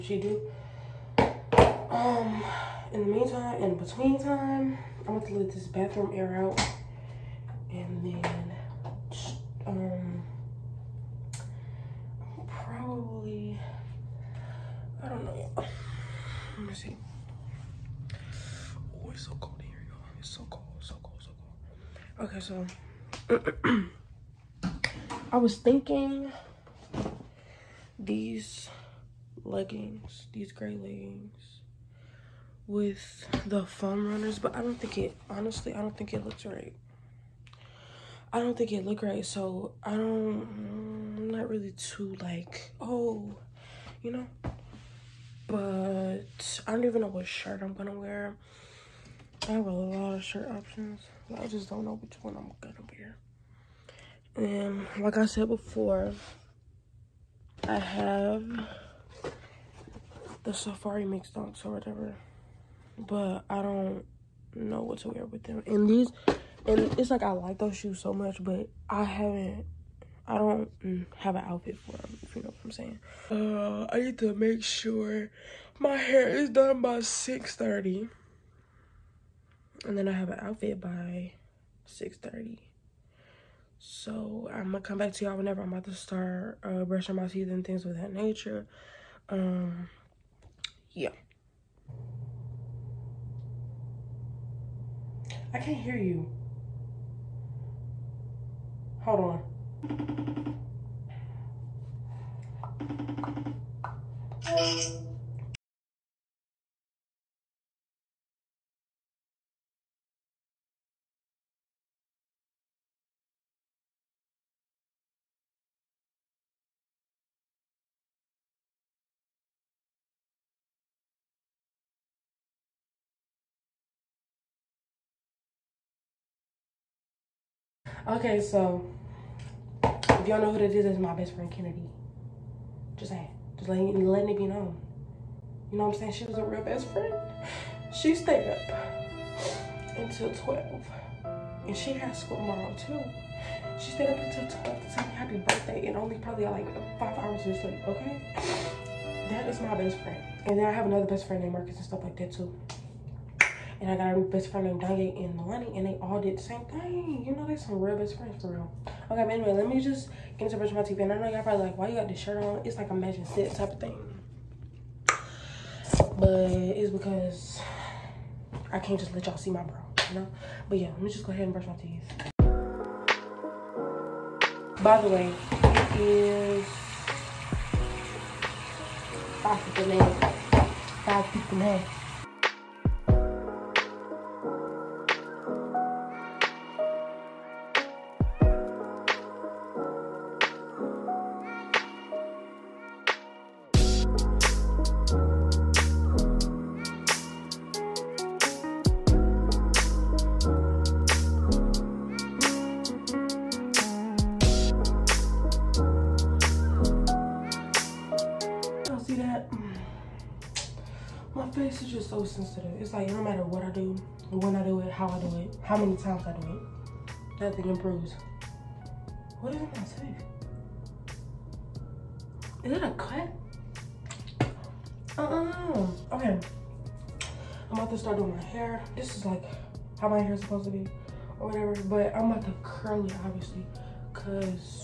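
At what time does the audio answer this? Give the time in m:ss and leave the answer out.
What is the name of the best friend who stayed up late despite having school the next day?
2:11.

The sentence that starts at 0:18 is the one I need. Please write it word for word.
Oh, it's so cold here, y'all.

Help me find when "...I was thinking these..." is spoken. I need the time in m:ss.
0:25.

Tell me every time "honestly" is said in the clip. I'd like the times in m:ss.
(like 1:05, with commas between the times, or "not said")
0:35.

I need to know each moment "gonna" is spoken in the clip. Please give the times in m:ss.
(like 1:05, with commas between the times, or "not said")
0:05, 0:47, 0:52.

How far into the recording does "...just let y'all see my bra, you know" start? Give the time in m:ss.
2:48.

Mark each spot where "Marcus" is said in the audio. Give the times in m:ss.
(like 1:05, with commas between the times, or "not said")
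2:31.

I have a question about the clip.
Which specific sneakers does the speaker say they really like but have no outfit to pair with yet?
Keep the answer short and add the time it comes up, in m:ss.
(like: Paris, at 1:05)
Safari Mix Dunks, at 1:00.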